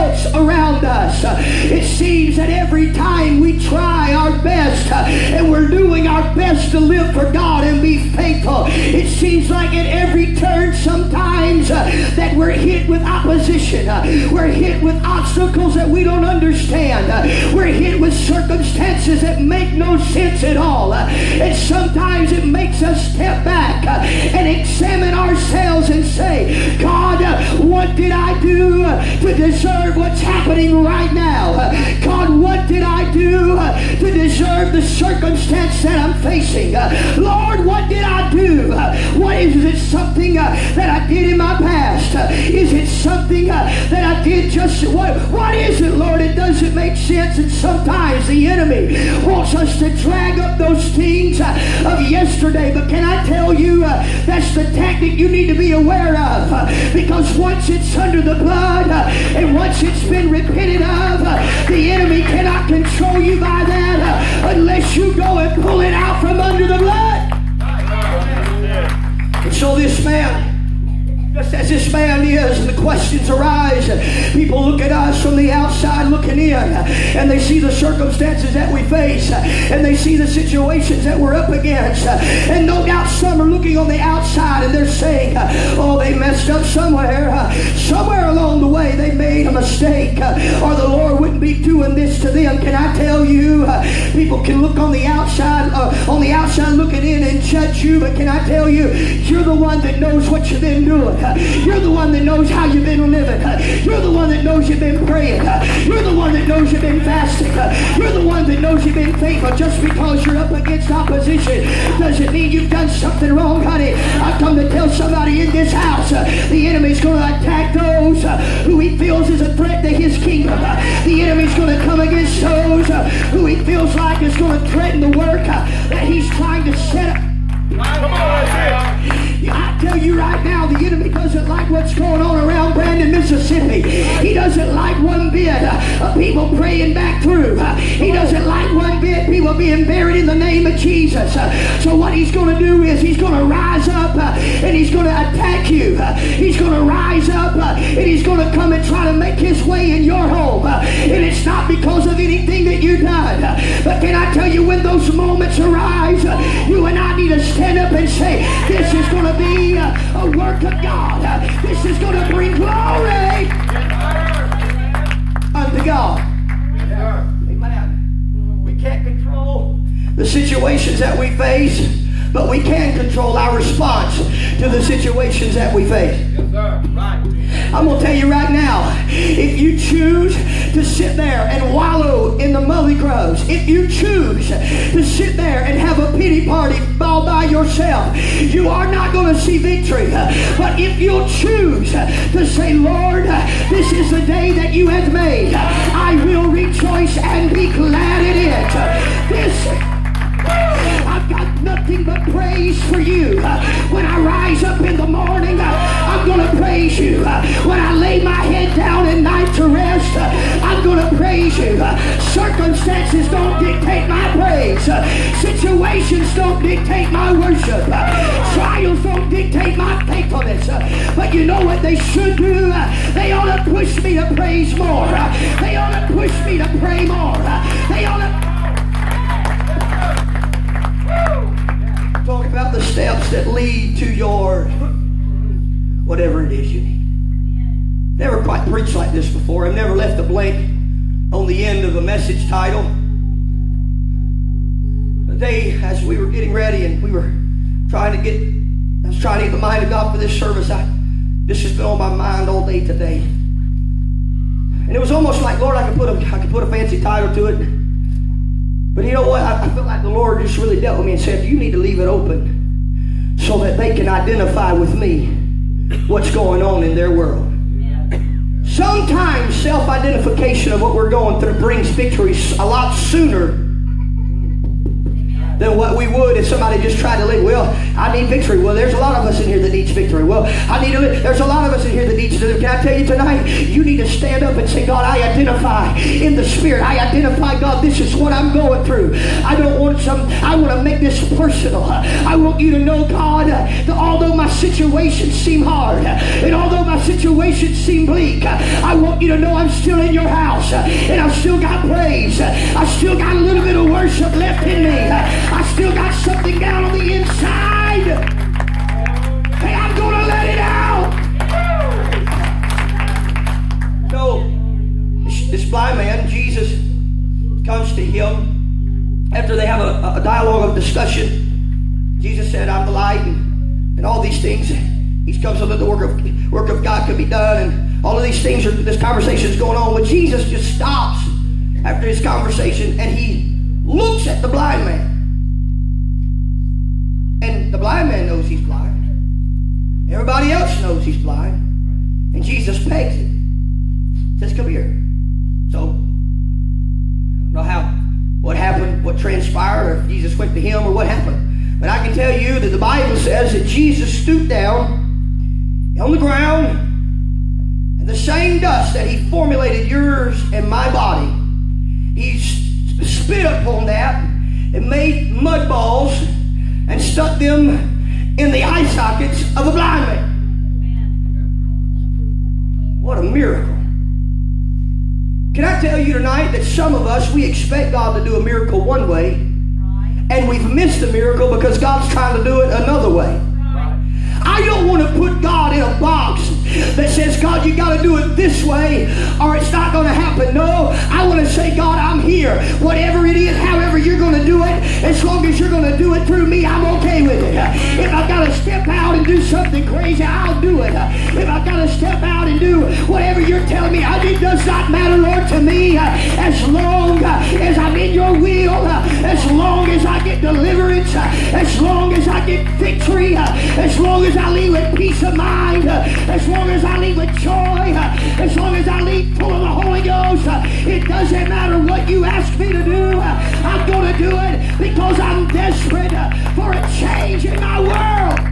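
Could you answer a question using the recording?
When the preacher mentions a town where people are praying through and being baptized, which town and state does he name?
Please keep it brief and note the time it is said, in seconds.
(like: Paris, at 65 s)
Brandon, Mississippi, at 132 s.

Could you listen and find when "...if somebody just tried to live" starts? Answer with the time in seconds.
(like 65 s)
276 s.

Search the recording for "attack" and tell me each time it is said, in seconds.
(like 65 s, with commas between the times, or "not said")
117 s, 145 s.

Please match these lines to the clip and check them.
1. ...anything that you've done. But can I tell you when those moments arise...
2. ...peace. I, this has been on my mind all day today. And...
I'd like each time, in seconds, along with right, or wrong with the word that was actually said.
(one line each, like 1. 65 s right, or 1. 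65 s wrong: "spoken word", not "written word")
1. 152 s right
2. 250 s wrong: "service", not "peace".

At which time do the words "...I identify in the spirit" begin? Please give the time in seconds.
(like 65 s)
285 s.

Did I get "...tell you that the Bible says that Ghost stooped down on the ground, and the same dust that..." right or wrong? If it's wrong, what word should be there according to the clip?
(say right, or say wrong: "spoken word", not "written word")
wrong: "Jesus", not "Ghost".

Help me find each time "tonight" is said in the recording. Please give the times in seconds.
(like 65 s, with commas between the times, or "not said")
283 s, 376 s.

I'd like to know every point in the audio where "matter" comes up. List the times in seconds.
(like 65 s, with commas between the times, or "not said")
404 s, 421 s.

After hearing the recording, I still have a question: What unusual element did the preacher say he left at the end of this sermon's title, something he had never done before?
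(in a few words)
a blank.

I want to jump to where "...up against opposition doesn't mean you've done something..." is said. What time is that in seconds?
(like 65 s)
110 s.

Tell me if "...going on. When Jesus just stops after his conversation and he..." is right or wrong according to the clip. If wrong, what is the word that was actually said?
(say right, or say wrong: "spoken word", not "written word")
right.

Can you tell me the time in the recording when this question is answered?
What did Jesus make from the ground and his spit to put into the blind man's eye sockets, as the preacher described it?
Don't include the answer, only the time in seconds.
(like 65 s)
365 s.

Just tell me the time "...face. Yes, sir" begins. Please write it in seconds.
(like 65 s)
175 s.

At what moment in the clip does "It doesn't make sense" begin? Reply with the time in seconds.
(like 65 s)
46 s.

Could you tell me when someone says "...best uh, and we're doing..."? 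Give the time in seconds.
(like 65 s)
4 s.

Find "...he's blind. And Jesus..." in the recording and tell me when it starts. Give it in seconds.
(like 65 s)
341 s.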